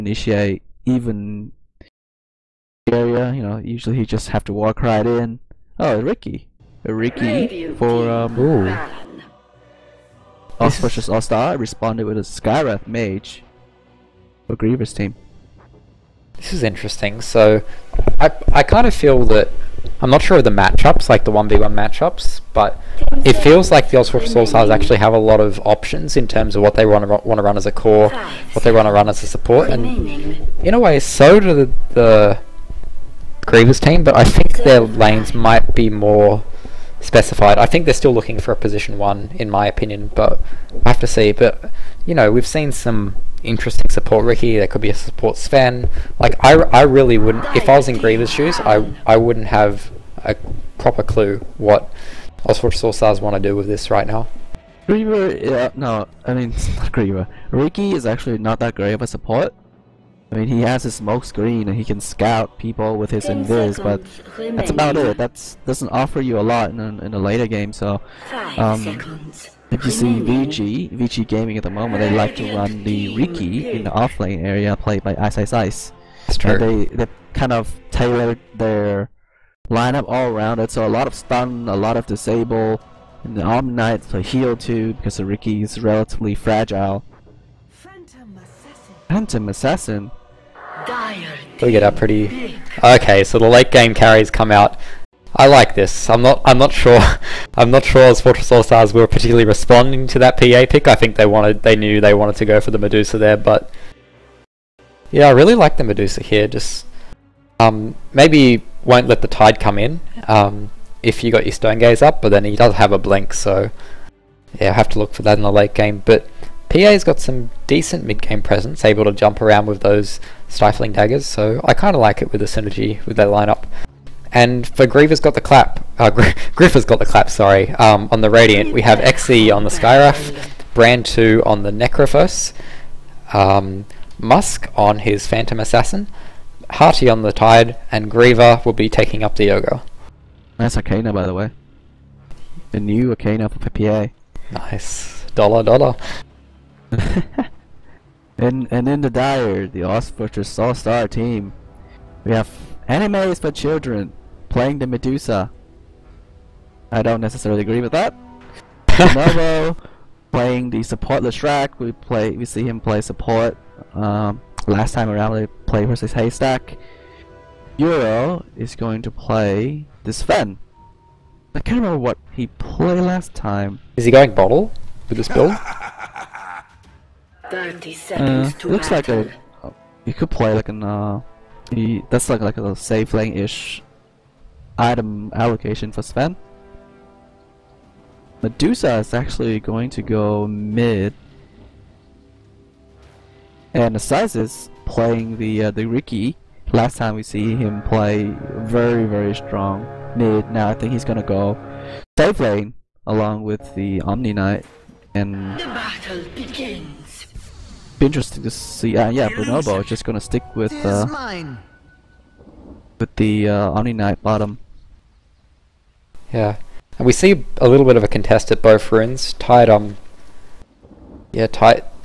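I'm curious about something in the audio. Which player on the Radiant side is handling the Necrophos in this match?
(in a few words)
Brand 2.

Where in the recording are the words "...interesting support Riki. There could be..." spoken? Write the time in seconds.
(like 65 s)
43 s.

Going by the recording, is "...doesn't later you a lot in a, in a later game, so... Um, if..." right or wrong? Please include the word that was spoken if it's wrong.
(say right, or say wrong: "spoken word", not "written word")
wrong: "offer", not "later".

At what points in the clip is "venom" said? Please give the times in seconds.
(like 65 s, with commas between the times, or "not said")
not said.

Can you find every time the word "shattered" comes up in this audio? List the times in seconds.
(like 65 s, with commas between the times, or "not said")
not said.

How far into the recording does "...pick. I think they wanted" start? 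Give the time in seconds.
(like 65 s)
100 s.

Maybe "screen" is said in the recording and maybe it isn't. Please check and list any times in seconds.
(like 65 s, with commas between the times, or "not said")
61 s.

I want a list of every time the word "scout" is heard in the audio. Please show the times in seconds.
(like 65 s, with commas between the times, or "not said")
61 s.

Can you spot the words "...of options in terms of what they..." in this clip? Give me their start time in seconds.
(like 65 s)
25 s.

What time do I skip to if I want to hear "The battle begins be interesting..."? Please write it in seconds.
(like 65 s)
205 s.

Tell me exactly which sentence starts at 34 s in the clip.
But I think their lanes might be more specified.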